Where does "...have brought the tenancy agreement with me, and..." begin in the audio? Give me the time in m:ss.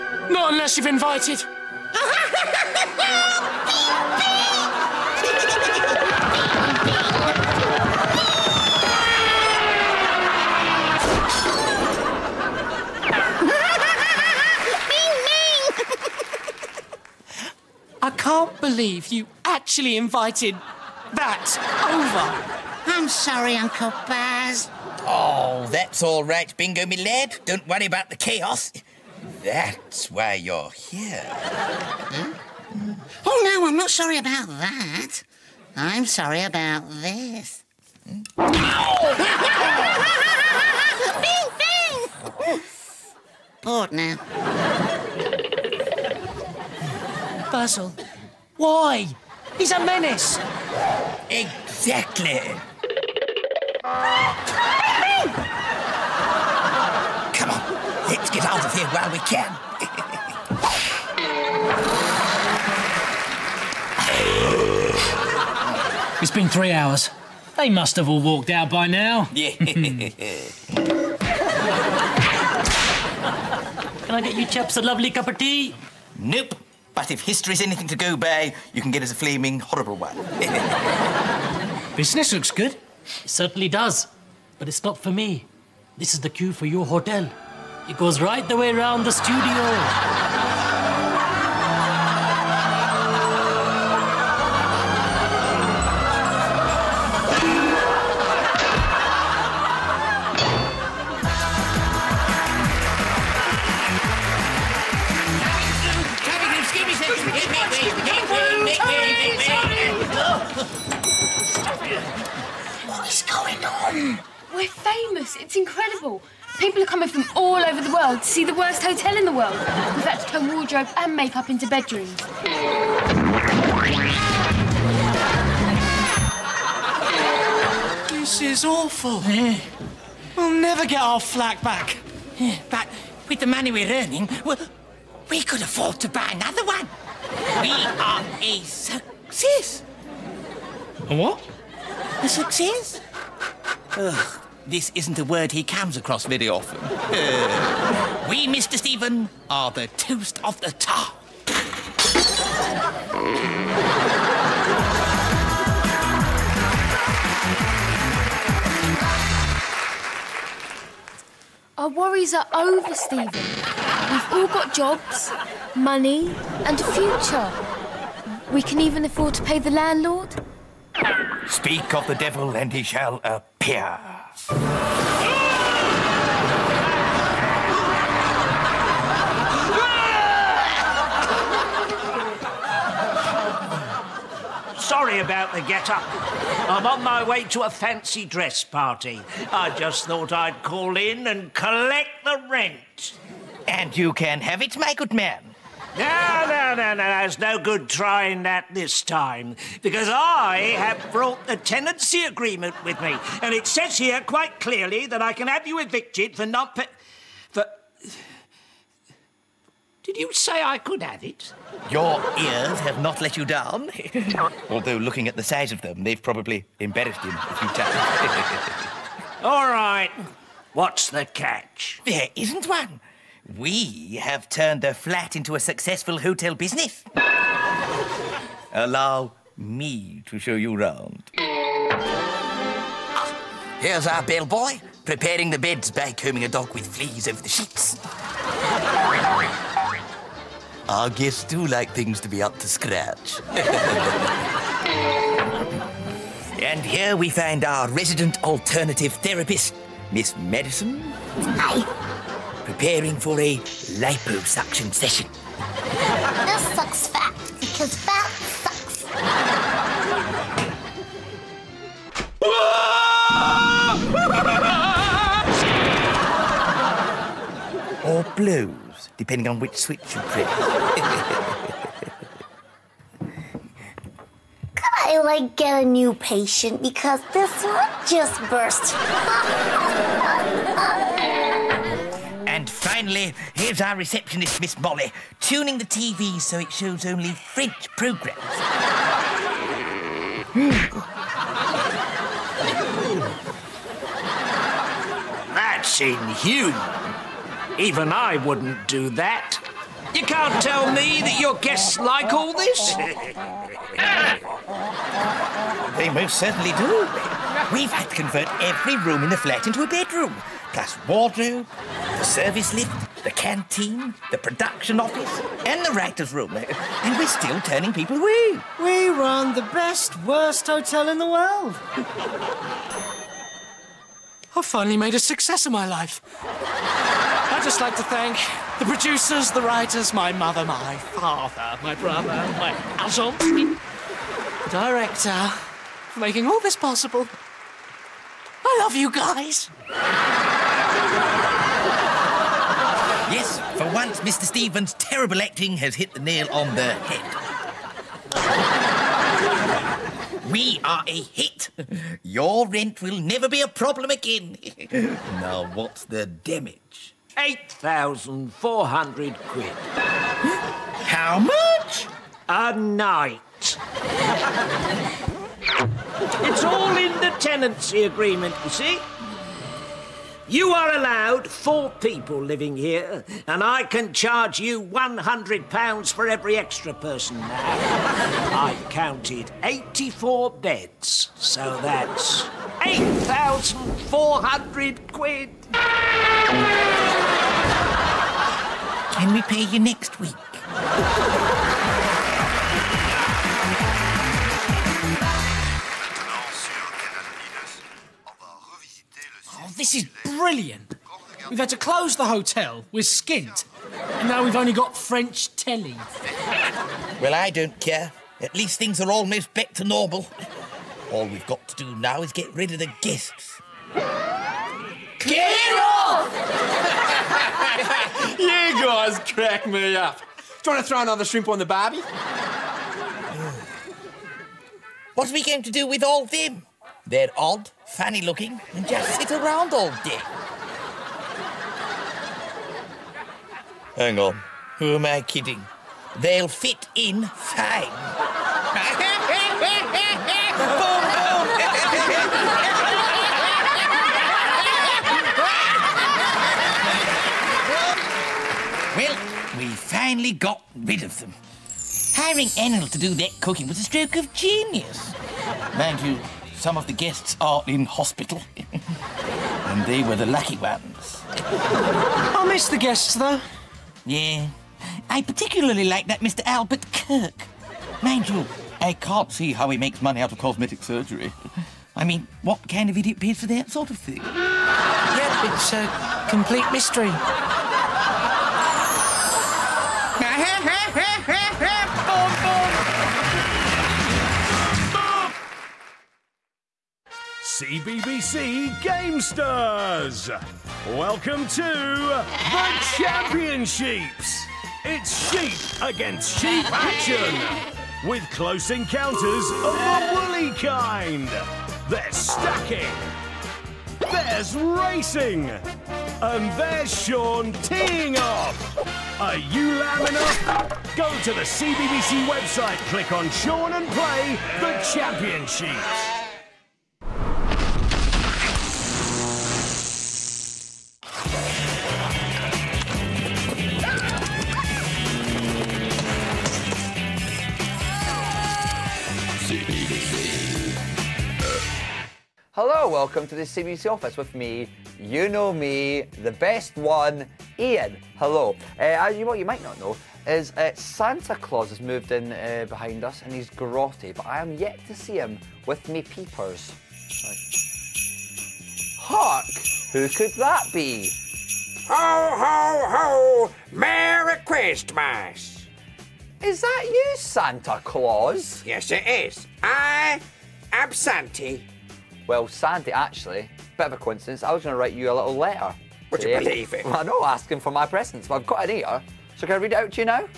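3:20.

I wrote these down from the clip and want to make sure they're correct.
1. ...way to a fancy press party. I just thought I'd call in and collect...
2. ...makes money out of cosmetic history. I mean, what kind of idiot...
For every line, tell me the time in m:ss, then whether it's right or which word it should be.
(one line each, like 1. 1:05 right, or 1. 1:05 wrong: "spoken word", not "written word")
1. 3:07 wrong: "dress", not "press"
2. 7:49 wrong: "surgery", not "history".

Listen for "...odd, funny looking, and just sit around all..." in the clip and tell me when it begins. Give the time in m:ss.
7:07.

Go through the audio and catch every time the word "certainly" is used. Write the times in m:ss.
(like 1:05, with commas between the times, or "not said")
1:23, 5:06.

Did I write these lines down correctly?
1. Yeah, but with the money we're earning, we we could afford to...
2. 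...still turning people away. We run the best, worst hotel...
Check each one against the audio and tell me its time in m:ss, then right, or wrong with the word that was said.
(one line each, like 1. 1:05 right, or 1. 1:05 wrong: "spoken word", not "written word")
1. 2:12 right
2. 5:17 right.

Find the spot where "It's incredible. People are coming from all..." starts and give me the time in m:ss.
1:55.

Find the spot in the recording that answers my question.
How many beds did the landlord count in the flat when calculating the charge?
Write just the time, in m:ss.
6:19.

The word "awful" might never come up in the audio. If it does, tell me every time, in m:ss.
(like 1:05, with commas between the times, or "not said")
2:08.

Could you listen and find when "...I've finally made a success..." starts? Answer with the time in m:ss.
5:24.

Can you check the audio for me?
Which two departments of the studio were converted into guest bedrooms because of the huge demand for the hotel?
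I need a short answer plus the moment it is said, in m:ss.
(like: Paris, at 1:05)
wardrobe and makeup, at 2:00.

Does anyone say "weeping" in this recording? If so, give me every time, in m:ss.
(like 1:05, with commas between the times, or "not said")
not said.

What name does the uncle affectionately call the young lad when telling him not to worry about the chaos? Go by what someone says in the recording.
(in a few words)
Bingo.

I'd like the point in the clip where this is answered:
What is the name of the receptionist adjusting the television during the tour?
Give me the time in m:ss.
4:44.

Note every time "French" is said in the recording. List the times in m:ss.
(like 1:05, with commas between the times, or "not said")
4:47, 6:44.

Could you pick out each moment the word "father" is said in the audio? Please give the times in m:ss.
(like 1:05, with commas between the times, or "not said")
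5:31.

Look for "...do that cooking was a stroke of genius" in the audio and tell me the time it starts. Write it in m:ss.
7:32.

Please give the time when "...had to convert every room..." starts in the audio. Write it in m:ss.
5:07.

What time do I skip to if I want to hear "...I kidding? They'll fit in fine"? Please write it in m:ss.
7:15.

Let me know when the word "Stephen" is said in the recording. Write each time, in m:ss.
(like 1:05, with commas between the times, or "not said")
2:28, 2:42, 5:44.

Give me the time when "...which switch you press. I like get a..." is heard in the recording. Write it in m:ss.
4:29.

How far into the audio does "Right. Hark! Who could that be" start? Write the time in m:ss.
9:07.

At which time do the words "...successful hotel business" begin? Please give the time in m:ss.
3:45.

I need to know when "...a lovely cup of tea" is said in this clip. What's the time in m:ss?
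1:14.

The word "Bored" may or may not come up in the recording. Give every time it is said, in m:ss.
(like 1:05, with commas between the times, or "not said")
0:43.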